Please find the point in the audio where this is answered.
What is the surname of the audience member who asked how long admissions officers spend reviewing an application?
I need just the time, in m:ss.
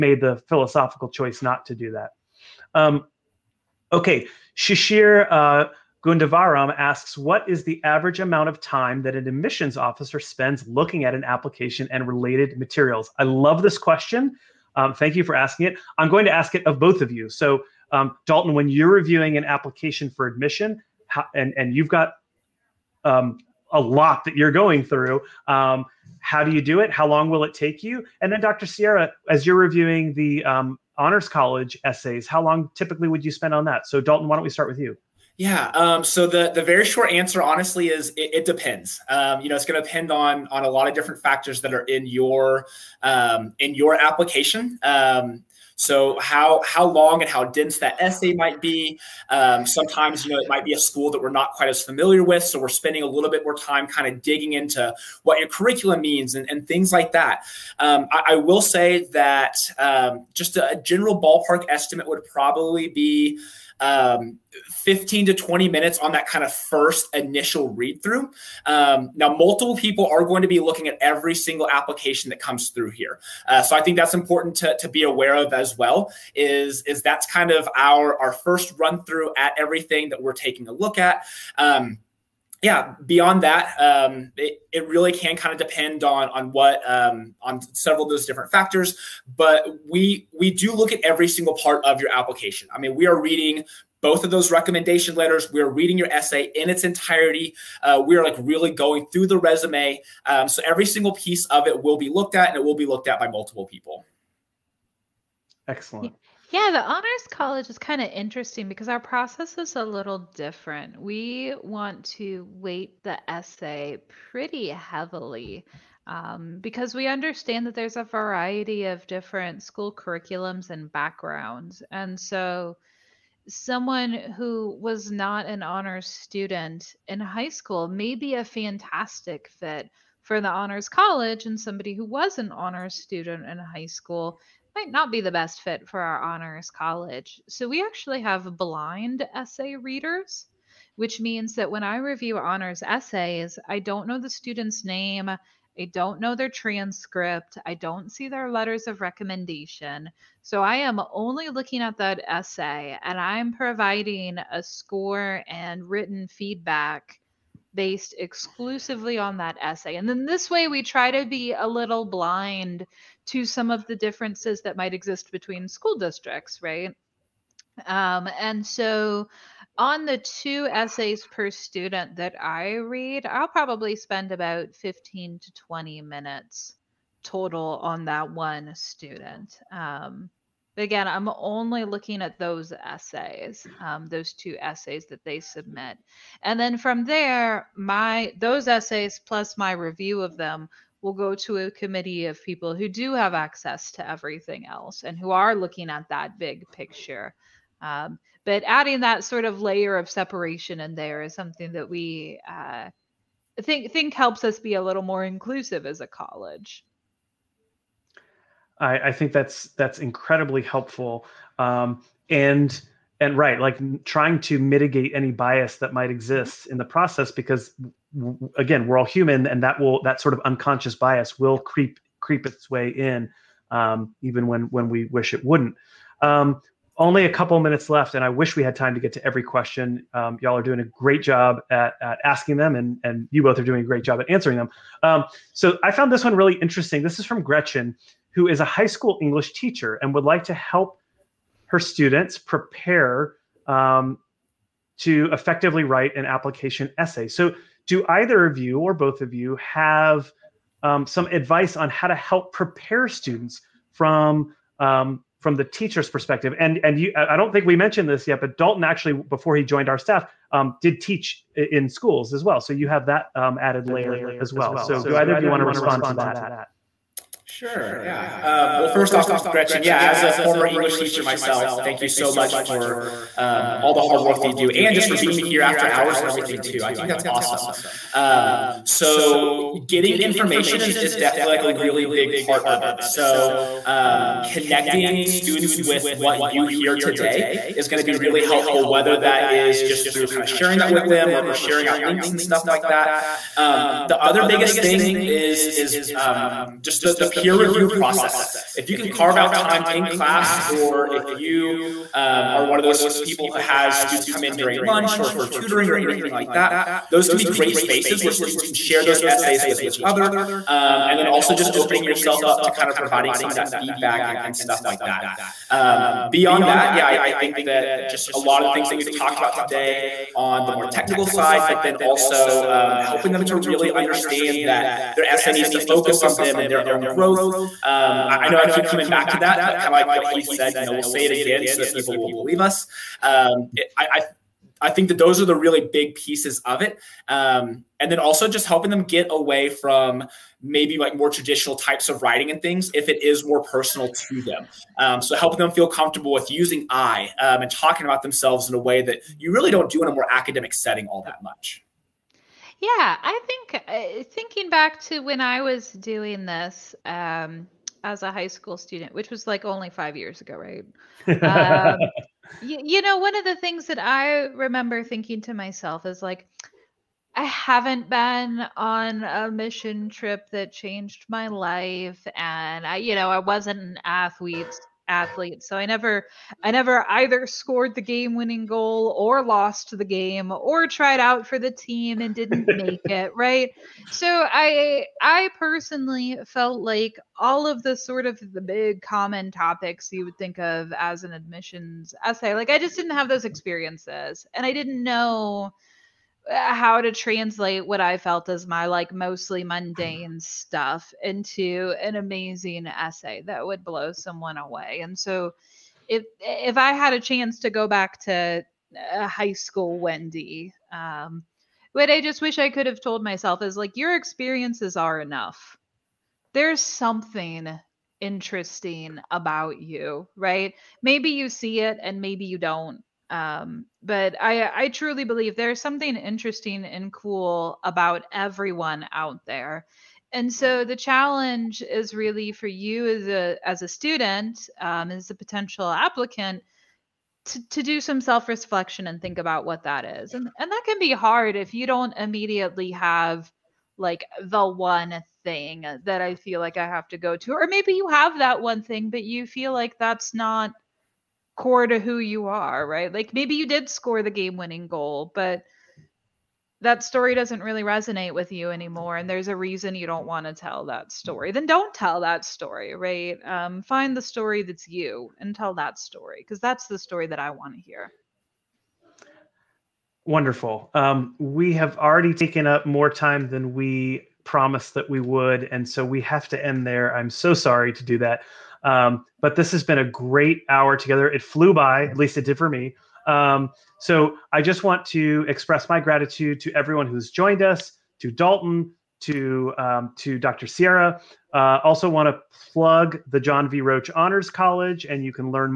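0:06.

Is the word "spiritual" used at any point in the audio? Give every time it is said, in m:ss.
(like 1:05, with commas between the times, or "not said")
not said.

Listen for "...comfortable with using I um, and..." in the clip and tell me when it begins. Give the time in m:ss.
5:45.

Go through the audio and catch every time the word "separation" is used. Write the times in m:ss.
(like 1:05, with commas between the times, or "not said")
3:20.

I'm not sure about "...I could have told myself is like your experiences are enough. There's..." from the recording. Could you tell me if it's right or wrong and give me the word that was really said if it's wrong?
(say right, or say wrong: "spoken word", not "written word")
right.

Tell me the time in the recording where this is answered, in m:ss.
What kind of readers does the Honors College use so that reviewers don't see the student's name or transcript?
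2:18.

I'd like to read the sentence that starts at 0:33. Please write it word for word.
So, Dalton, why don't we start with you?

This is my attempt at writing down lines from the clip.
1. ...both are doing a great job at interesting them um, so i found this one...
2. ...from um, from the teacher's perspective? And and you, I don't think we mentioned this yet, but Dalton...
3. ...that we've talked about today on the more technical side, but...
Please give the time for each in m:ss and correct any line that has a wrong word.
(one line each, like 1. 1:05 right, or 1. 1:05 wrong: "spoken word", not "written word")
1. 3:53 wrong: "answering", not "interesting"
2. 4:13 right
3. 5:18 right.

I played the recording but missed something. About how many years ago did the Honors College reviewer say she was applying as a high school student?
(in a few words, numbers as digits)
5 years.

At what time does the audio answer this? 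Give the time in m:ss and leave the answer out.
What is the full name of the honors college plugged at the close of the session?
8:13.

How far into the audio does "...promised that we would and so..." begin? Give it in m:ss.
7:54.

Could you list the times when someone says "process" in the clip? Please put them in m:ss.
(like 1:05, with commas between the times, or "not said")
1:48, 3:36, 4:57.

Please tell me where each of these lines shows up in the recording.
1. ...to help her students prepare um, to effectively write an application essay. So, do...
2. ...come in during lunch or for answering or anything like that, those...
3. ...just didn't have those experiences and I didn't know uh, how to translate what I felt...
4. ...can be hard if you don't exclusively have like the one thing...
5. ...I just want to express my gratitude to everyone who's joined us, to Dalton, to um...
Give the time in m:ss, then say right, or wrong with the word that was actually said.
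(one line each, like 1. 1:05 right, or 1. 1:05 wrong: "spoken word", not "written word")
1. 4:00 right
2. 5:04 wrong: "tutoring", not "answering"
3. 6:32 right
4. 7:20 wrong: "immediately", not "exclusively"
5. 8:04 right.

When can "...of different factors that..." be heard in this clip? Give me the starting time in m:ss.
0:40.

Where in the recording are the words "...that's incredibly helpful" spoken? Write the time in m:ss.
3:29.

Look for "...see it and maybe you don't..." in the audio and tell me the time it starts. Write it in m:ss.
7:01.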